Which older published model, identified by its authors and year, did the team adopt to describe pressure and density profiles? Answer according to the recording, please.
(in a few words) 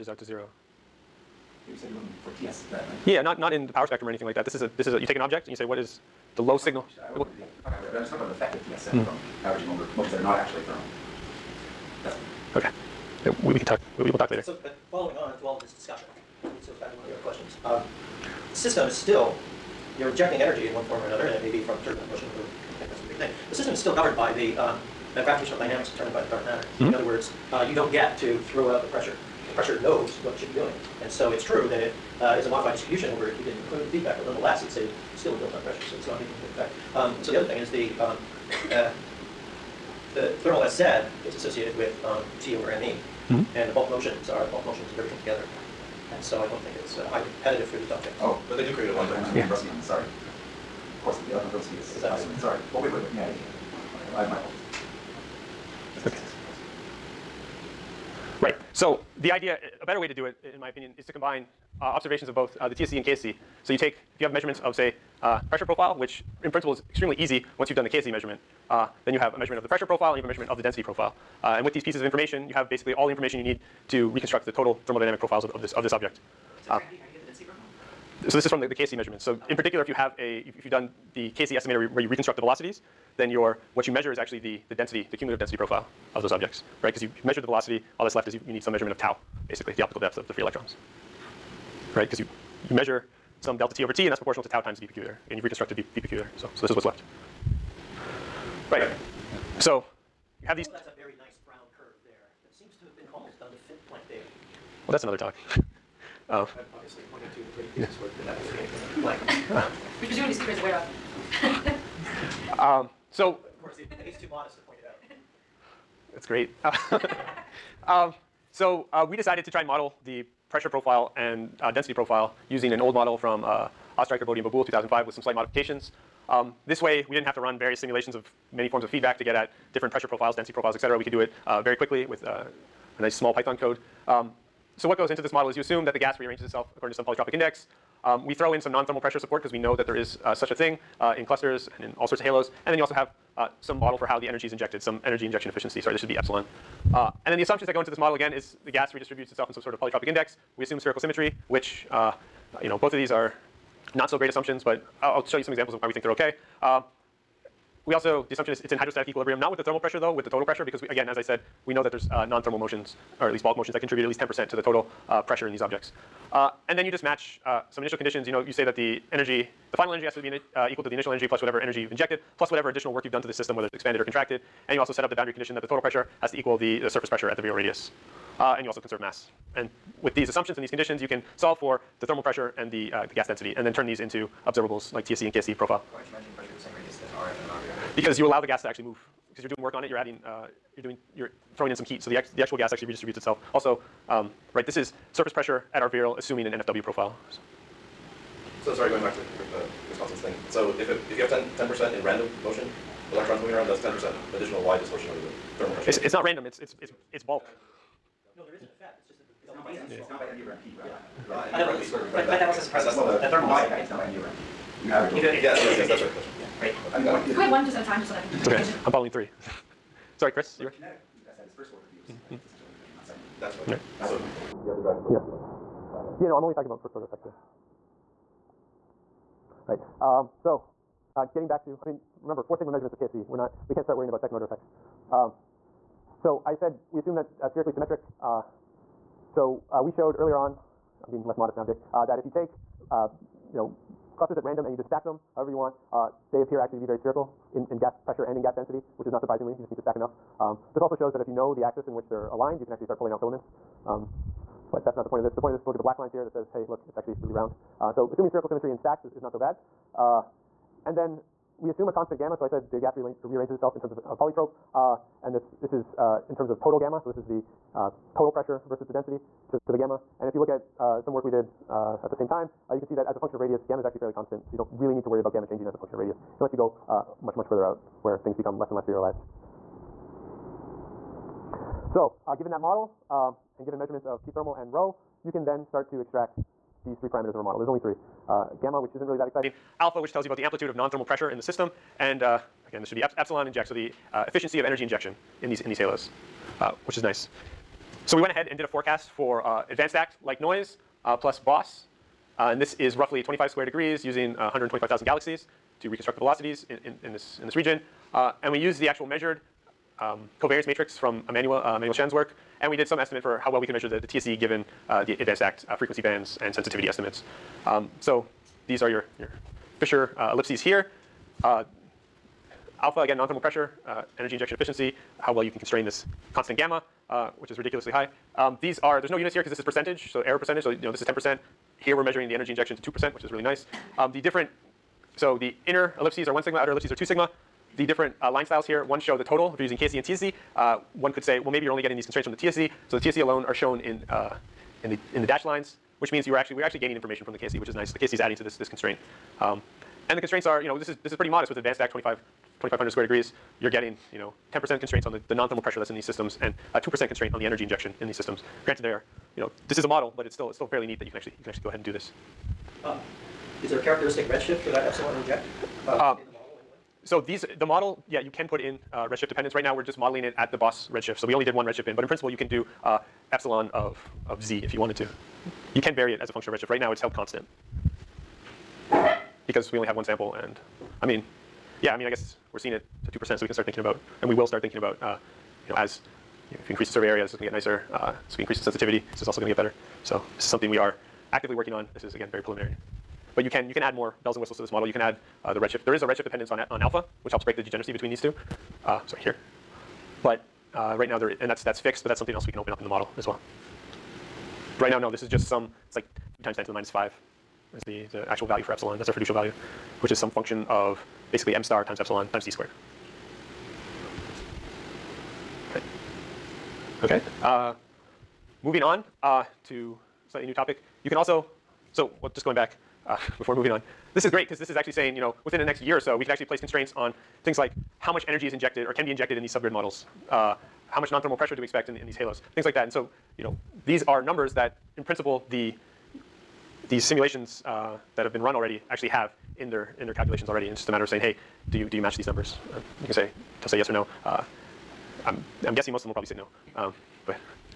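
Ostriker, Bode, and Babul 2005.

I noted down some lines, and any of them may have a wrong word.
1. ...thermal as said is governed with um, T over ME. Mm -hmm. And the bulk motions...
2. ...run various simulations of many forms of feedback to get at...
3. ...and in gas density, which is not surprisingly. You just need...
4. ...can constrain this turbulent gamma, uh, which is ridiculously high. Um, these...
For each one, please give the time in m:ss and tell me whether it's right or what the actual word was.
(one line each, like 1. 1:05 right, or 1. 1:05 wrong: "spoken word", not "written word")
1. 0:40 wrong: "associated", not "governed"
2. 2:07 right
3. 4:08 right
4. 5:25 wrong: "constant", not "turbulent".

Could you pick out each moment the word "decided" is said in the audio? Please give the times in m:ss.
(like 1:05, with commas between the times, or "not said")
1:59.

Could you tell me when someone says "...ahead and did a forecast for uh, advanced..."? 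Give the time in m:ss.
4:58.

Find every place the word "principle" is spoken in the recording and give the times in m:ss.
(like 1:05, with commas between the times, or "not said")
1:06, 6:12, 7:15.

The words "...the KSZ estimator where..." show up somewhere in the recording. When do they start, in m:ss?
1:21.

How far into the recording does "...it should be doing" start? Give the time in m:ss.
0:30.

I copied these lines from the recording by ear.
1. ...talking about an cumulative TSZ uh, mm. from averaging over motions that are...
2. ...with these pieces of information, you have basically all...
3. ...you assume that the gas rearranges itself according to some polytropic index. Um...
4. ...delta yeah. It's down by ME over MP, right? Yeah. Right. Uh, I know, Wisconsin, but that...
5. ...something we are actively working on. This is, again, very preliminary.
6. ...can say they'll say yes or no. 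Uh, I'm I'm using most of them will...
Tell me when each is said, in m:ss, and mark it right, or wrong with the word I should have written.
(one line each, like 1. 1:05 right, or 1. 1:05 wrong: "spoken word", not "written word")
1. 0:08 wrong: "effective", not "cumulative"
2. 1:11 right
3. 2:15 right
4. 3:29 wrong: "But", not "Wisconsin"
5. 6:30 right
6. 7:23 wrong: "guessing", not "using".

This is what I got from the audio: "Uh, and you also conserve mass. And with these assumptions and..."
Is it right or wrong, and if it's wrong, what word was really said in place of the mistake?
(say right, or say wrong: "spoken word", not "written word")
right.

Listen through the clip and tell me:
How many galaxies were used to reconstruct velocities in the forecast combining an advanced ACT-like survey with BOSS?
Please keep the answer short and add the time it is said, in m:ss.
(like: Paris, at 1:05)
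125,000, at 5:04.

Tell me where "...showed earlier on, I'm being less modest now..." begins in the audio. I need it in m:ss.
3:59.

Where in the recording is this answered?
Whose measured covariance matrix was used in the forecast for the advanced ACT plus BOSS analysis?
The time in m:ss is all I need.
5:11.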